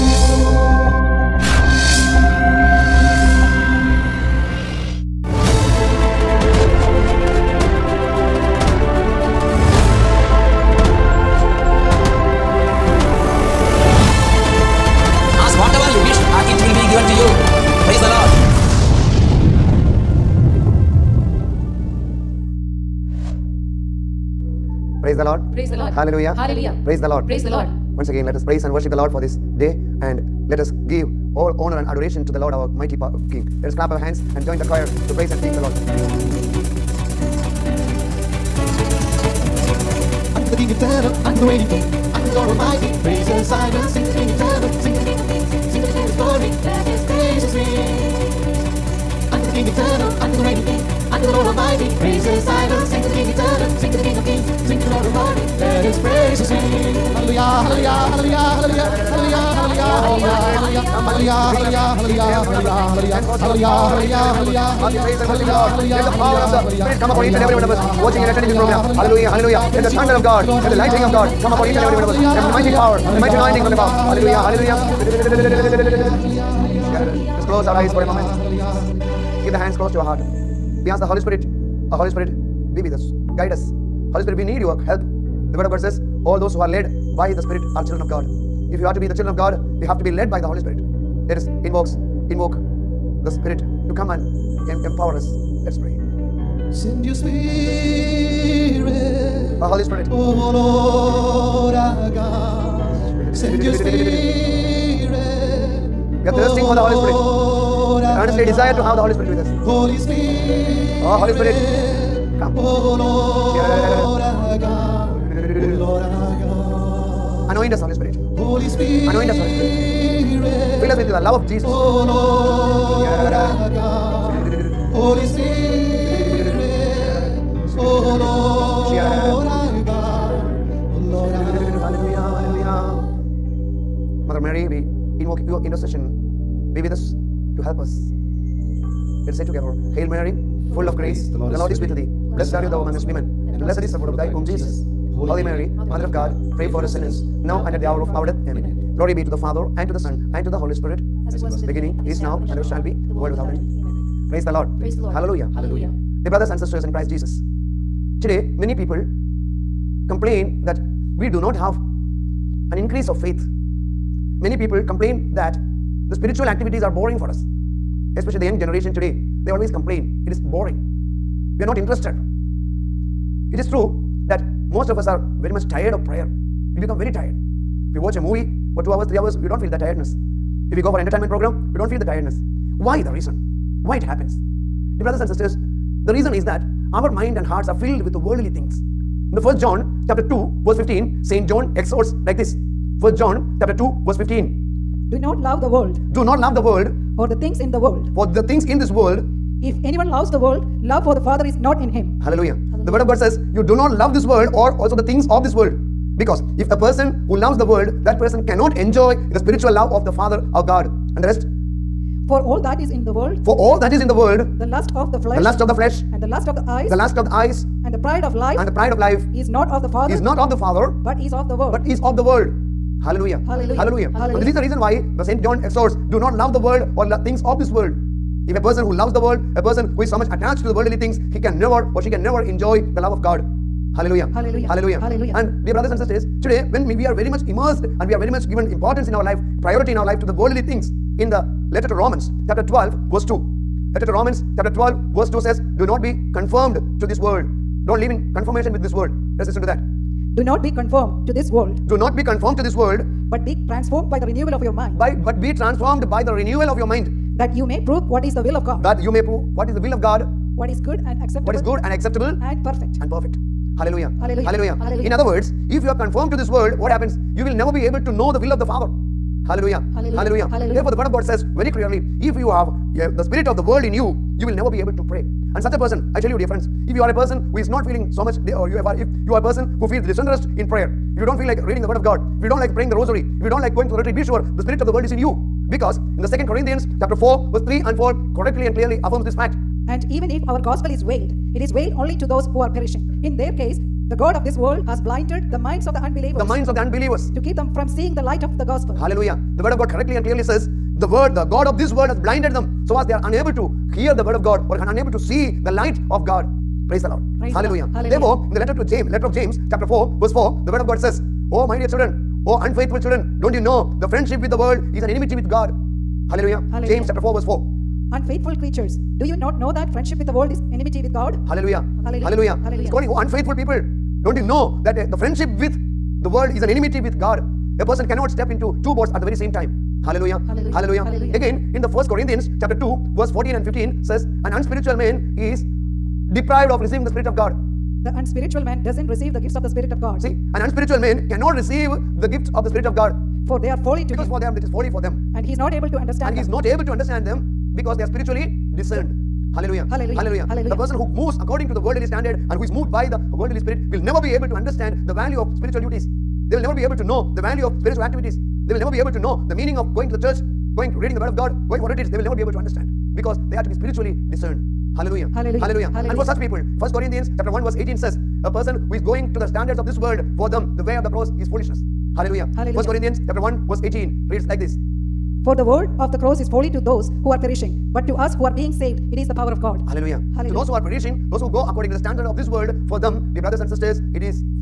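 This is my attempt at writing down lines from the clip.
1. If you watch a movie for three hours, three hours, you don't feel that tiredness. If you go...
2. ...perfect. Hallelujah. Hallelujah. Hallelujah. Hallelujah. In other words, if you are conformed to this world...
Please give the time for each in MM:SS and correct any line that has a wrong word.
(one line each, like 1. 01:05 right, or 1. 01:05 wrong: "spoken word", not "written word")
1. 02:57 wrong: "two", not "three"
2. 04:23 right.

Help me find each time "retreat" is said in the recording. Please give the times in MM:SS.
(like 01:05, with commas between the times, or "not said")
04:43, 06:01.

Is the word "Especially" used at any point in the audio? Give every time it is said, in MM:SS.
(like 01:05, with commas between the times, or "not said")
02:48.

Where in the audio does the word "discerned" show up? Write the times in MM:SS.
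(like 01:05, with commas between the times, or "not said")
05:48, 06:04.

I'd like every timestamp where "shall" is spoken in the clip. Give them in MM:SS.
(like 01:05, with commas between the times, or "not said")
02:32.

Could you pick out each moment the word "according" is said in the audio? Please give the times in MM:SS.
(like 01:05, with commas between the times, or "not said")
05:51, 06:21.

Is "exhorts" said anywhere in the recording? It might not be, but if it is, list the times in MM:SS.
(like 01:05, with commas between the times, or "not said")
03:11, 03:45.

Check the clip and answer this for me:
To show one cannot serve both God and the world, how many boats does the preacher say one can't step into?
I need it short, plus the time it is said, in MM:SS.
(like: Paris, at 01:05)
2, at 05:28.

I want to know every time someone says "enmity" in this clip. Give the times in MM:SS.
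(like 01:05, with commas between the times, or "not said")
05:15, 05:20, 05:26.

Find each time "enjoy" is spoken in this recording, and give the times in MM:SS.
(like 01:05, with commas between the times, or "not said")
03:28, 03:52.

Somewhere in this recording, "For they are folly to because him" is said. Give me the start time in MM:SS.
05:43.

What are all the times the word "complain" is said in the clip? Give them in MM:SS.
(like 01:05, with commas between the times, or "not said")
02:40, 02:44, 02:49.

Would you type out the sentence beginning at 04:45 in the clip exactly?
Because in the second Corinthians chapter 4, verse 3 and 4 correctly and clearly affirms this fact.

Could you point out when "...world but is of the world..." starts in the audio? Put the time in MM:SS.
03:41.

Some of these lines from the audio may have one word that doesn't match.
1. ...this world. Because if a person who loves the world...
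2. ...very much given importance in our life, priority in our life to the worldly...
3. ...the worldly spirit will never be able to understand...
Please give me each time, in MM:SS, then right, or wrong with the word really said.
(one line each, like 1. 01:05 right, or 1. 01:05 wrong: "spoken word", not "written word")
1. 03:25 right
2. 03:58 right
3. 05:53 right.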